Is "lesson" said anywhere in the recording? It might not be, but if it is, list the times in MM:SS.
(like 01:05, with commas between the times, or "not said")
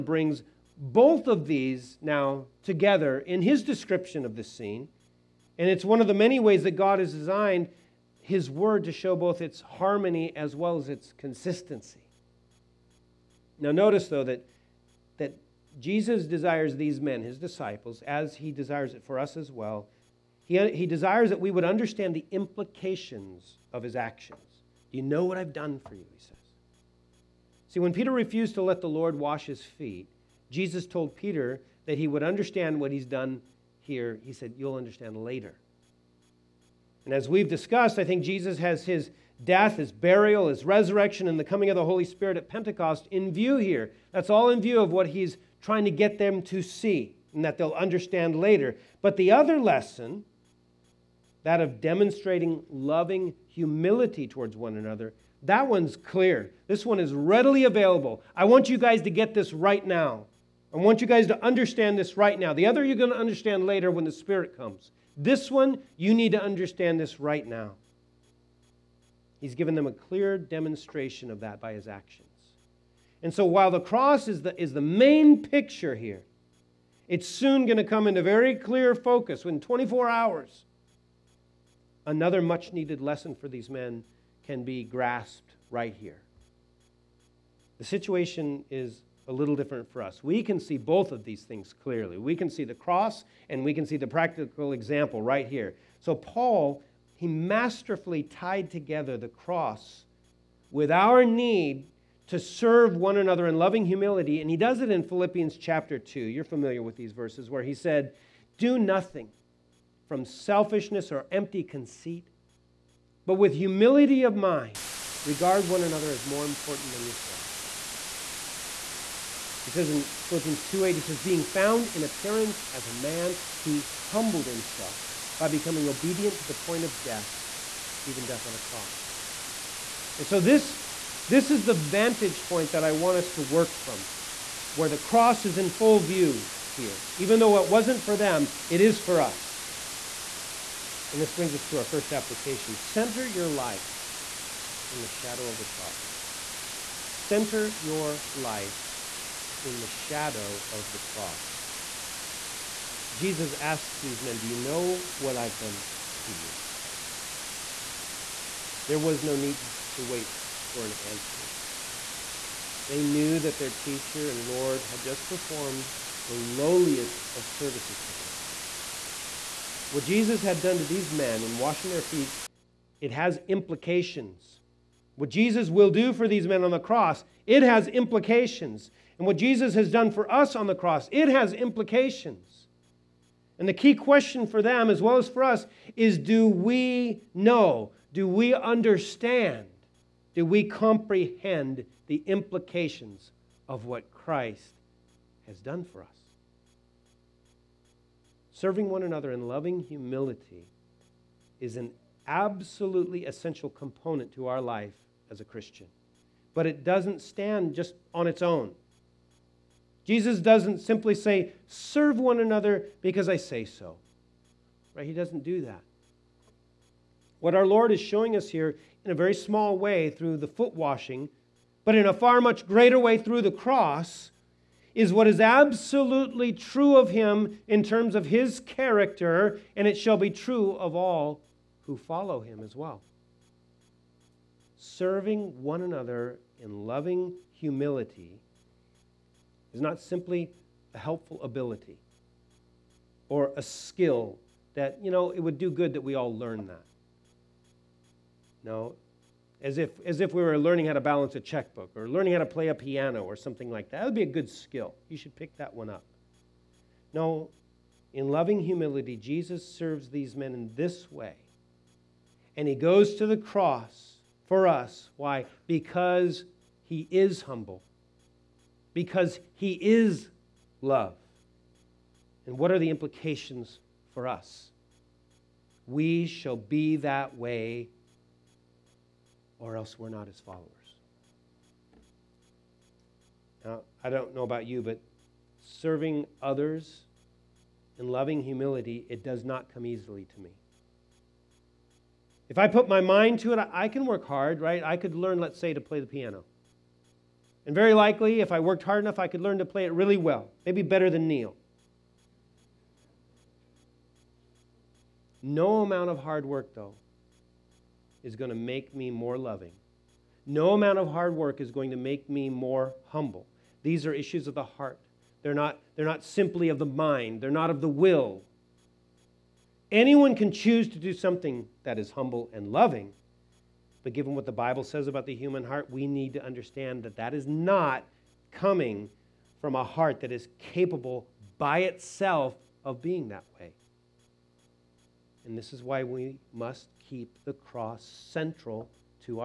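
00:49, 01:22.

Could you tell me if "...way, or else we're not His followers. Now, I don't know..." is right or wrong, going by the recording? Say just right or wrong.
right.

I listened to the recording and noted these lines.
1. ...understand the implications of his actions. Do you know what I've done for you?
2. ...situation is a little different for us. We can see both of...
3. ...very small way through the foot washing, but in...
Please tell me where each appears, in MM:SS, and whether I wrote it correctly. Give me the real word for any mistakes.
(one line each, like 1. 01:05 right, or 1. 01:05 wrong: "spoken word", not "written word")
1. 00:21 right
2. 01:27 right
3. 03:39 right.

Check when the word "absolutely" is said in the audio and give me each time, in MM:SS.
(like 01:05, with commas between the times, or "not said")
03:22, 03:45.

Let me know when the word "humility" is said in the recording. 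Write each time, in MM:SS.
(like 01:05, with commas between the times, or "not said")
00:53, 01:43, 01:53, 03:19, 03:57, 04:18, 04:48.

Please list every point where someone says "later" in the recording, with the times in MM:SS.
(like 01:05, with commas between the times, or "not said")
00:35, 00:48, 01:03.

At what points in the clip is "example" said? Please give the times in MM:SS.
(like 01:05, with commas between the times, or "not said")
01:34.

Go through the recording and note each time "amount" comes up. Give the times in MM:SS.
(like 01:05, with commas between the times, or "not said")
05:05, 05:10.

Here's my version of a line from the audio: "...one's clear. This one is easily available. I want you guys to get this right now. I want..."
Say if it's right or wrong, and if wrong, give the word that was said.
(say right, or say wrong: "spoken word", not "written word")
wrong: "readily", not "easily".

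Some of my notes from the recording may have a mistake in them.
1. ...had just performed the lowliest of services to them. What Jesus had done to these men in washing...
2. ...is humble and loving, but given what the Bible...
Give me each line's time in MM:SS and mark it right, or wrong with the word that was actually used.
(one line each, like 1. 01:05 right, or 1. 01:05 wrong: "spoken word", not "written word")
1. 02:44 right
2. 05:21 right.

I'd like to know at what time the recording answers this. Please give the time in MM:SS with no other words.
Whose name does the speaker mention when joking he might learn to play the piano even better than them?
05:01.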